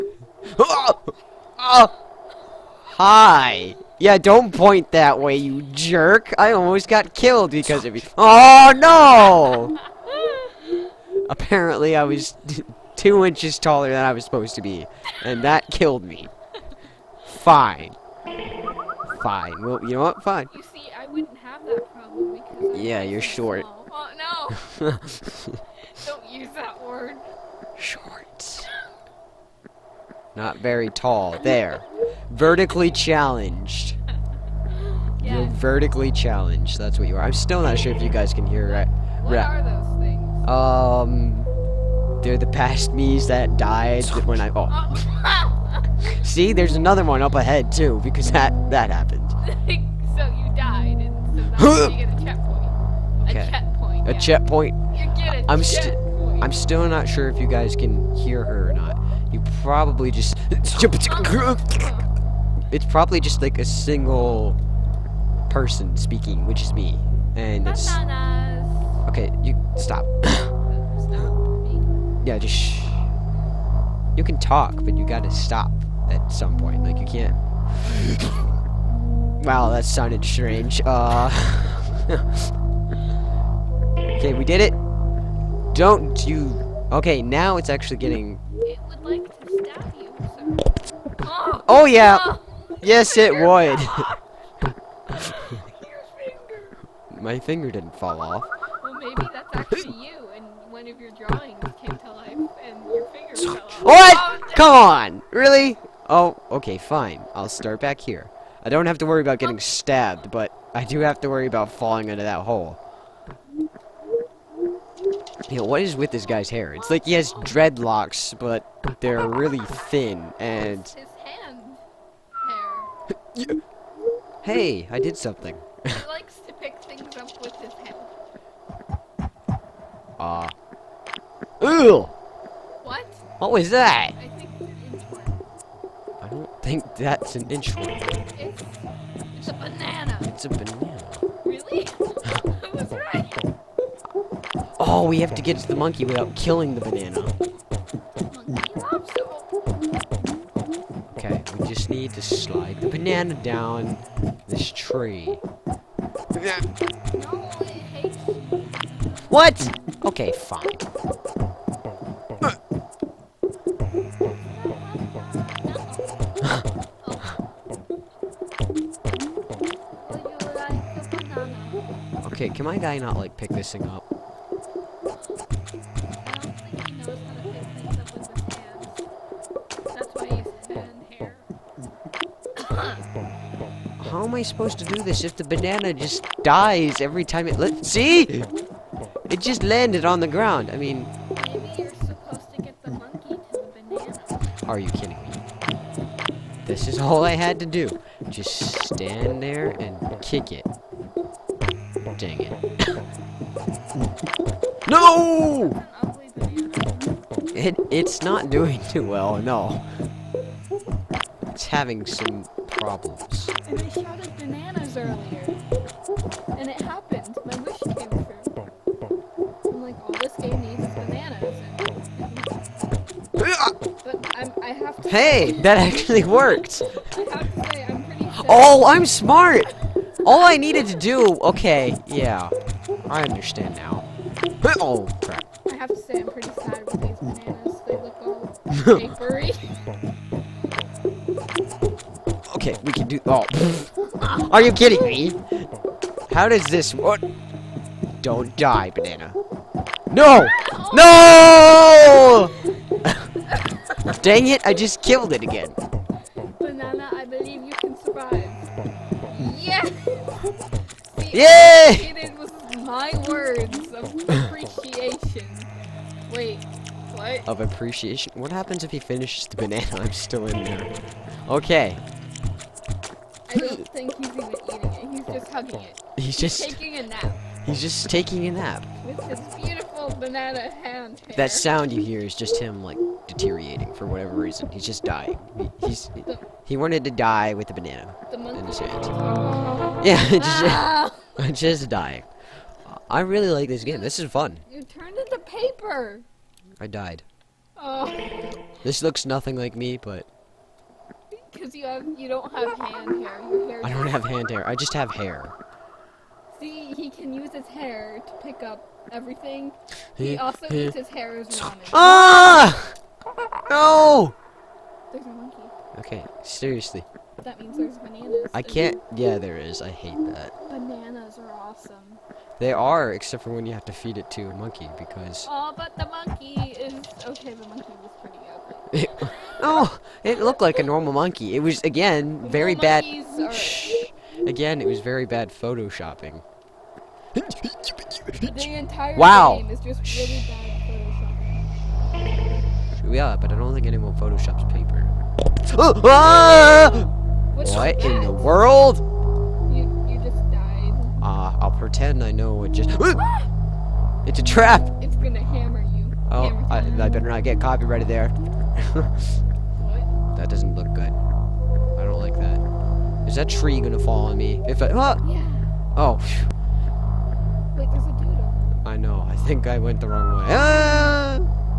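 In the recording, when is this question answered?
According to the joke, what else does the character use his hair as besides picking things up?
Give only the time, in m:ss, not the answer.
5:11.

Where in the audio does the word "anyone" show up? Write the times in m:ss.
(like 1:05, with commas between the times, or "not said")
5:43.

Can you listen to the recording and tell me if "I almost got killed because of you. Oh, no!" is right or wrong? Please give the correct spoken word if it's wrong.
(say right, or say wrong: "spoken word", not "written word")
right.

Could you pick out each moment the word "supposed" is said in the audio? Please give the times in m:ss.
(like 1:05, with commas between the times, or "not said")
0:14, 3:04.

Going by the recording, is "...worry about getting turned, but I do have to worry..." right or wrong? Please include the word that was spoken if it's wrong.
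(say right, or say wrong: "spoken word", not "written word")
wrong: "stabbed", not "turned".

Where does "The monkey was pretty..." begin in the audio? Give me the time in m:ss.
5:27.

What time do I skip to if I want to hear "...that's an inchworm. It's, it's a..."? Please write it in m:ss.
2:18.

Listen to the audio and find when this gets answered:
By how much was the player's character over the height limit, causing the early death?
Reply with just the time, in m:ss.
0:12.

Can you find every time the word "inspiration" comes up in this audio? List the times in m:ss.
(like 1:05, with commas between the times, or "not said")
not said.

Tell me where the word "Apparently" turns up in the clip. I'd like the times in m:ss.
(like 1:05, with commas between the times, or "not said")
0:11.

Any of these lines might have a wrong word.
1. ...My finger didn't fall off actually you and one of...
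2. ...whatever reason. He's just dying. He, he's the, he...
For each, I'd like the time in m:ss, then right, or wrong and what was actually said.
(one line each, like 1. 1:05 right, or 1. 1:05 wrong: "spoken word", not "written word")
1. 1:37 right
2. 4:44 right.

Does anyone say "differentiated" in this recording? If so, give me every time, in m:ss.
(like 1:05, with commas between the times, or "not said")
not said.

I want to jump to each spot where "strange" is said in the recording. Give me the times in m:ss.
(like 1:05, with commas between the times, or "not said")
1:20.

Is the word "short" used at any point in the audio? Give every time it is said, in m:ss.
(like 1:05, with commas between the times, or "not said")
0:23, 0:27.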